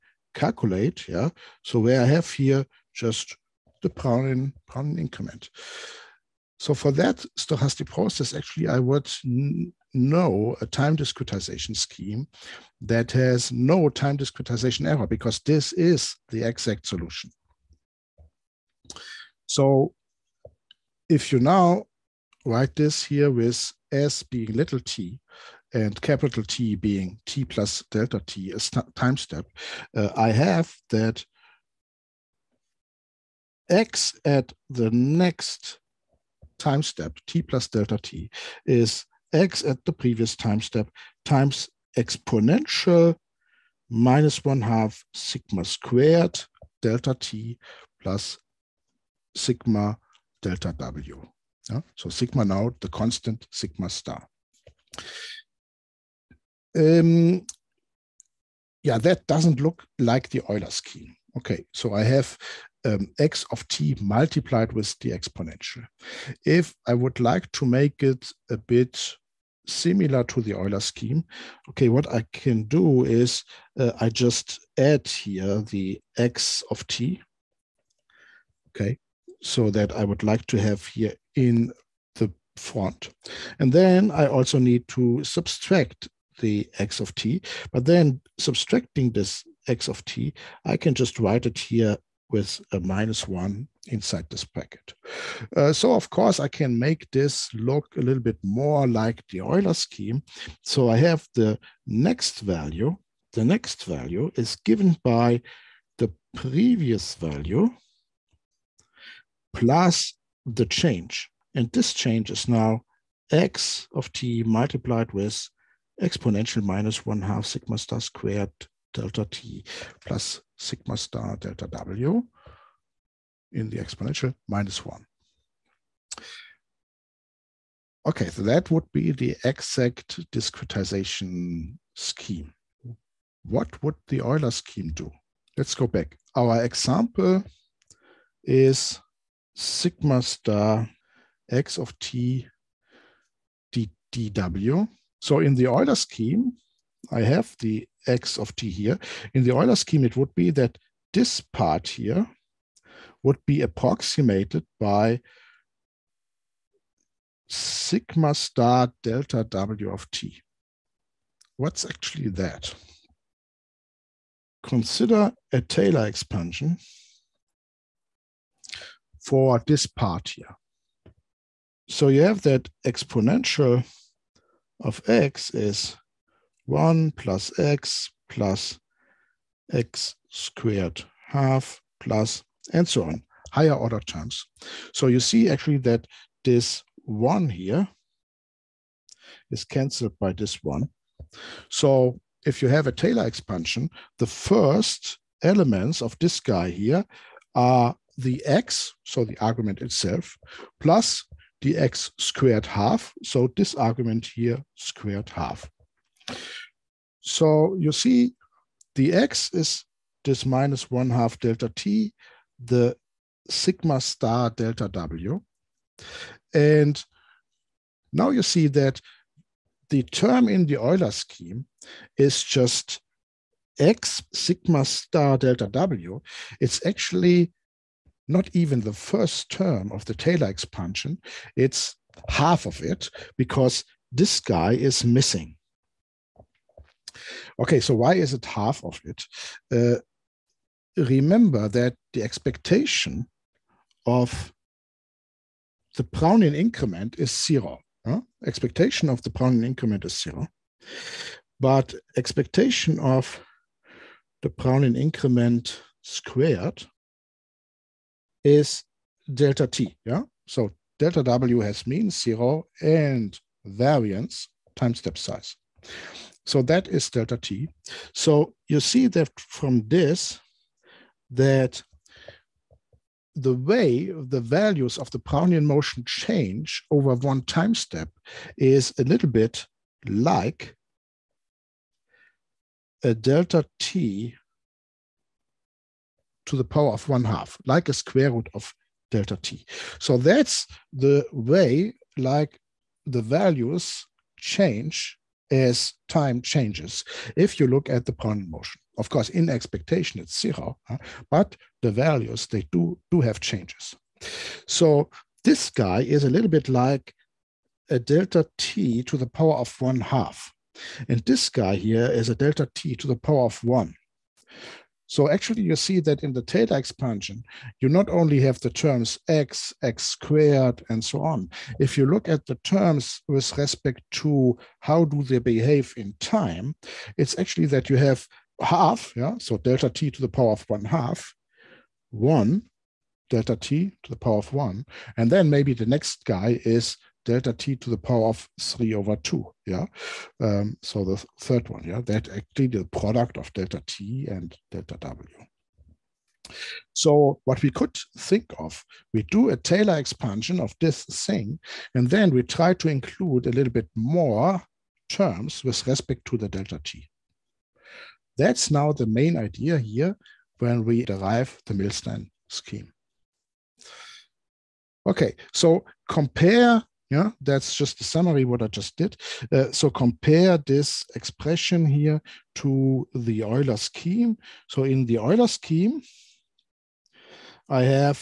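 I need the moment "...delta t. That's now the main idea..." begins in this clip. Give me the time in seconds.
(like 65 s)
356 s.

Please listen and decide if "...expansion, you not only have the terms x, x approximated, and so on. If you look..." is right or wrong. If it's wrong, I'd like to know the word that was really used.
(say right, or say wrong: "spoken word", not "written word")
wrong: "squared", not "approximated".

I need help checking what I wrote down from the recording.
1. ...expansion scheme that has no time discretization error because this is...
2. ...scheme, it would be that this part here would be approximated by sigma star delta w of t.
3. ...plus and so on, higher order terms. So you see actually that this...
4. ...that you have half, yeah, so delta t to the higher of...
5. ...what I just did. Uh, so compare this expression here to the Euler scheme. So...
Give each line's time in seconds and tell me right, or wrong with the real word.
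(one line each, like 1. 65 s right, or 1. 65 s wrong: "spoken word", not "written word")
1. 10 s wrong: "discretization", not "expansion"
2. 149 s right
3. 181 s right
4. 327 s wrong: "power", not "higher"
5. 368 s right.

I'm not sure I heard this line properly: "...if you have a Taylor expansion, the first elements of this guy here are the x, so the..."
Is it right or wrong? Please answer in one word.
right.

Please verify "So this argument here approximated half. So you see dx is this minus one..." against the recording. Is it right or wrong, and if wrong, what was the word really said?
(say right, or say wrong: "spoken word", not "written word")
wrong: "squared", not "approximated".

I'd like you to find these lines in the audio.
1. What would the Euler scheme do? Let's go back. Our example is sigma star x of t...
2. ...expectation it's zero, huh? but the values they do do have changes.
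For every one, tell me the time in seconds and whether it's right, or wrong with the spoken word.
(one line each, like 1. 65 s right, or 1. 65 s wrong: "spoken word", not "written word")
1. 133 s right
2. 299 s right.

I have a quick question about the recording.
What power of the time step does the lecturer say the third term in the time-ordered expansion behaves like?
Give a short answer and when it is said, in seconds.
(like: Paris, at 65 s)
3/2, at 338 s.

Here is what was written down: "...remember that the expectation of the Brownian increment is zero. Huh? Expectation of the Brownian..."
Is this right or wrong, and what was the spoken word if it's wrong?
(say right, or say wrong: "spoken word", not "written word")
right.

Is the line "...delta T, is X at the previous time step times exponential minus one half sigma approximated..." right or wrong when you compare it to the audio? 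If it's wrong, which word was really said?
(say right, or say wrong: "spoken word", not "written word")
wrong: "squared", not "approximated".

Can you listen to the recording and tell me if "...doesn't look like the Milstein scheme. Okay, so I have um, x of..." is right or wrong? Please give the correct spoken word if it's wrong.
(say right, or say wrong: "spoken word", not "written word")
wrong: "Euler", not "Milstein".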